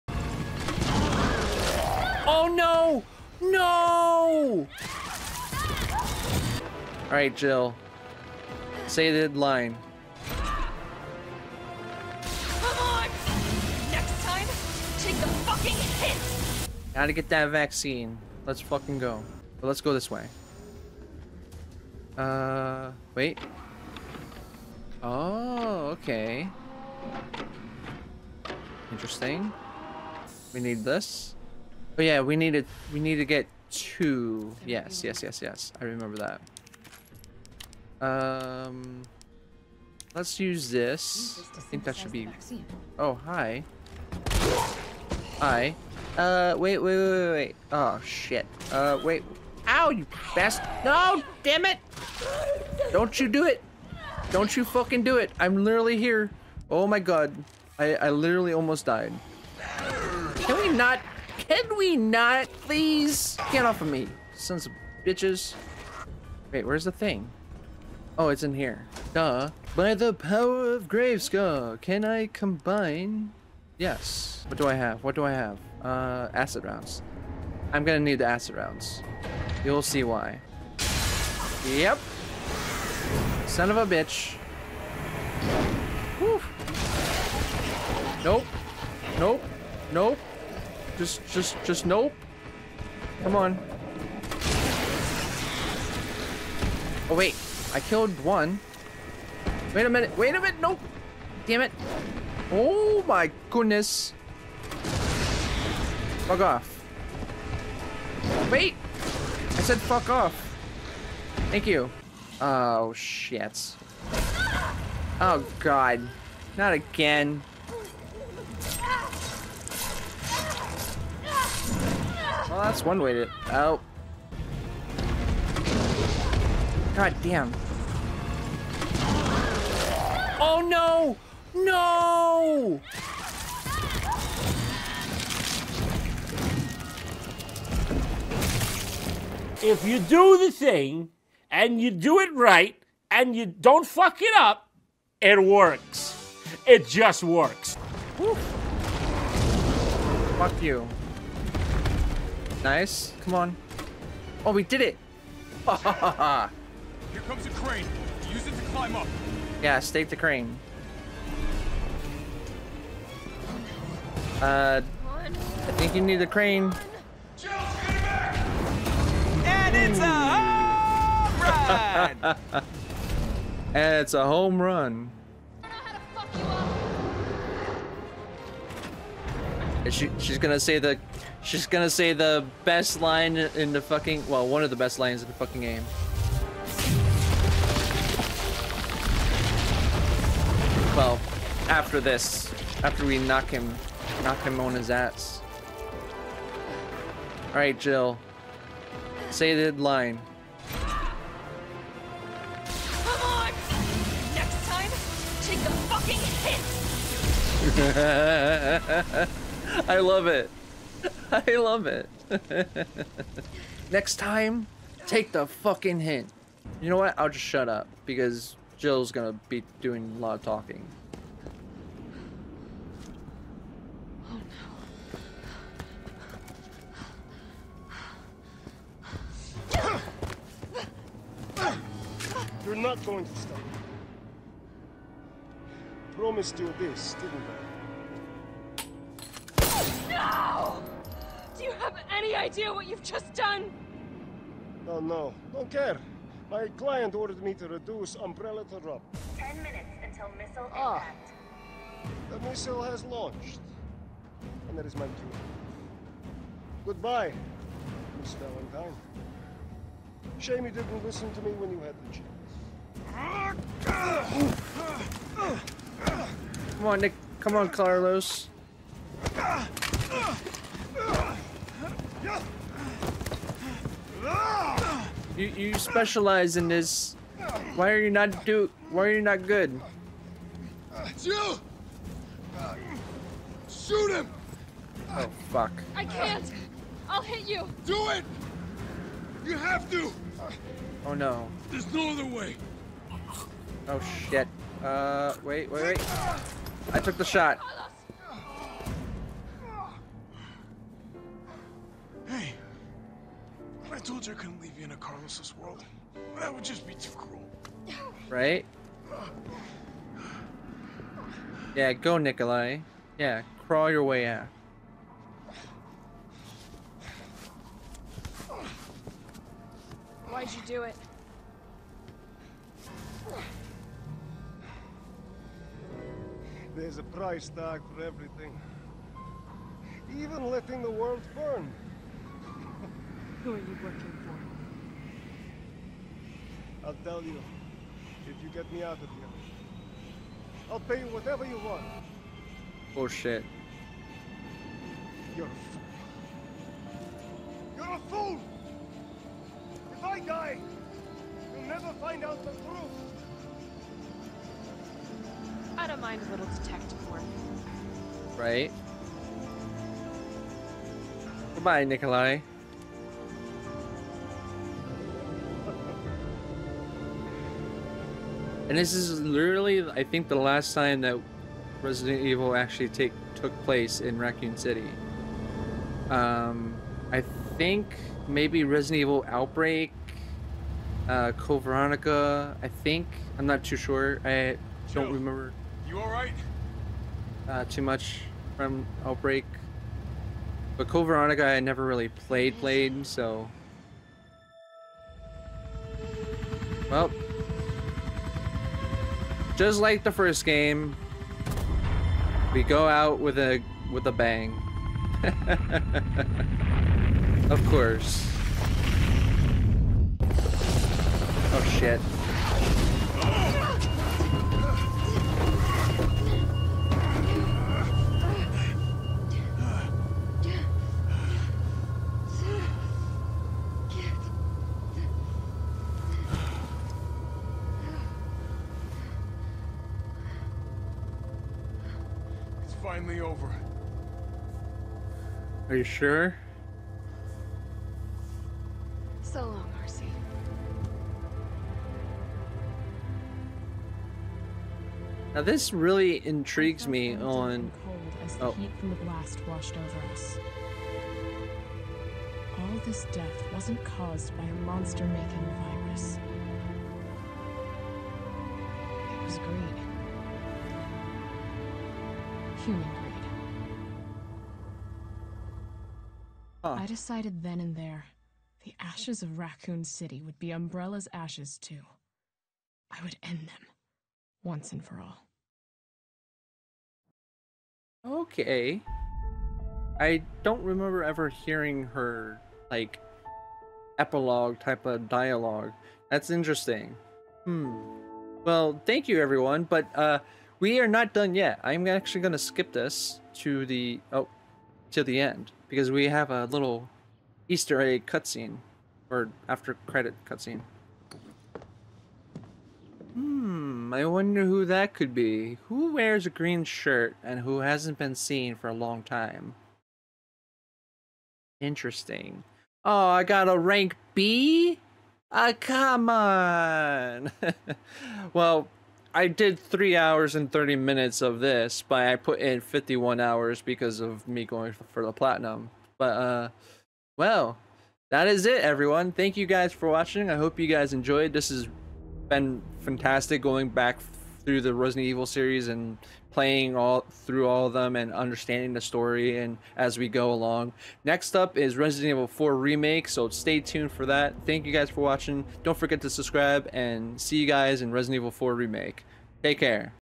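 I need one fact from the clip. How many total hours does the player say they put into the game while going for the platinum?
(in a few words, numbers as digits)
51.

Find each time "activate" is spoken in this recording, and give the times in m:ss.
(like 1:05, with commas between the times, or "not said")
not said.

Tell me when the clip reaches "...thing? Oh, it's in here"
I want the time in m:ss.
1:06.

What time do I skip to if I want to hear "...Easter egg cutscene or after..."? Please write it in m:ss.
8:17.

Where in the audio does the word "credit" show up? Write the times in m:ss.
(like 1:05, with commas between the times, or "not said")
8:19.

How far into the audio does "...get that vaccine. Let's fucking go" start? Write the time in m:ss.
0:17.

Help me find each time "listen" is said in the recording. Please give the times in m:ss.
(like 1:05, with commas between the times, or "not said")
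4:21.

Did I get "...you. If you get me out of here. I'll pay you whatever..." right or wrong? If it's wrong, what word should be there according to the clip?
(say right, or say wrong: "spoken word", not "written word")
right.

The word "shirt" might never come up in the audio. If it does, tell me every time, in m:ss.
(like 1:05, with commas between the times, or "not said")
8:26.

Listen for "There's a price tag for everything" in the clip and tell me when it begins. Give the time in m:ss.
5:26.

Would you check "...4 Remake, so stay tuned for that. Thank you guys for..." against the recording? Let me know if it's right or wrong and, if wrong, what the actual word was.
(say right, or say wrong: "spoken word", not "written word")
right.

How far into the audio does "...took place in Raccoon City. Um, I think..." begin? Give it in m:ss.
6:13.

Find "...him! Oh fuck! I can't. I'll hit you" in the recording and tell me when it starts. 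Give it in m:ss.
4:44.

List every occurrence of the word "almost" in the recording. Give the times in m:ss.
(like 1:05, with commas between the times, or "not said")
0:58.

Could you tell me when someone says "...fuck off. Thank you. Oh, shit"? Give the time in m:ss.
1:49.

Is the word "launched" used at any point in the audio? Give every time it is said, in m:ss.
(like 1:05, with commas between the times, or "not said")
4:13.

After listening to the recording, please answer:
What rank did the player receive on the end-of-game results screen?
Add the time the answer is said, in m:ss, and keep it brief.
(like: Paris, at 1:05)
B, at 8:33.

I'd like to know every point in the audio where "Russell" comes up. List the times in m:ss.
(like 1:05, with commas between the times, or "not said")
not said.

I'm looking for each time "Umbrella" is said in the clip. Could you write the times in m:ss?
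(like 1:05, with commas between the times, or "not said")
4:08, 7:50.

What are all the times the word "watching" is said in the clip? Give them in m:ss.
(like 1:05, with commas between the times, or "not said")
8:49, 9:05.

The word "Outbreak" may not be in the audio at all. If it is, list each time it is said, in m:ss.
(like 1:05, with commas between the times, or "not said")
6:19, 6:29.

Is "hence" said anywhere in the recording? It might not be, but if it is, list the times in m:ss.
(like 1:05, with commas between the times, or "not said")
not said.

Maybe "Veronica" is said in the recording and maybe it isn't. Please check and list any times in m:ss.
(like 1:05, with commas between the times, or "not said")
6:21, 6:31.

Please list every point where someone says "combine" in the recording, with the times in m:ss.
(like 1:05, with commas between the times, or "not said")
1:12.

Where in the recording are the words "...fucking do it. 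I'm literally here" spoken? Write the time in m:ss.
0:54.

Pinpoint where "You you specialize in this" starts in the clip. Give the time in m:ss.
4:35.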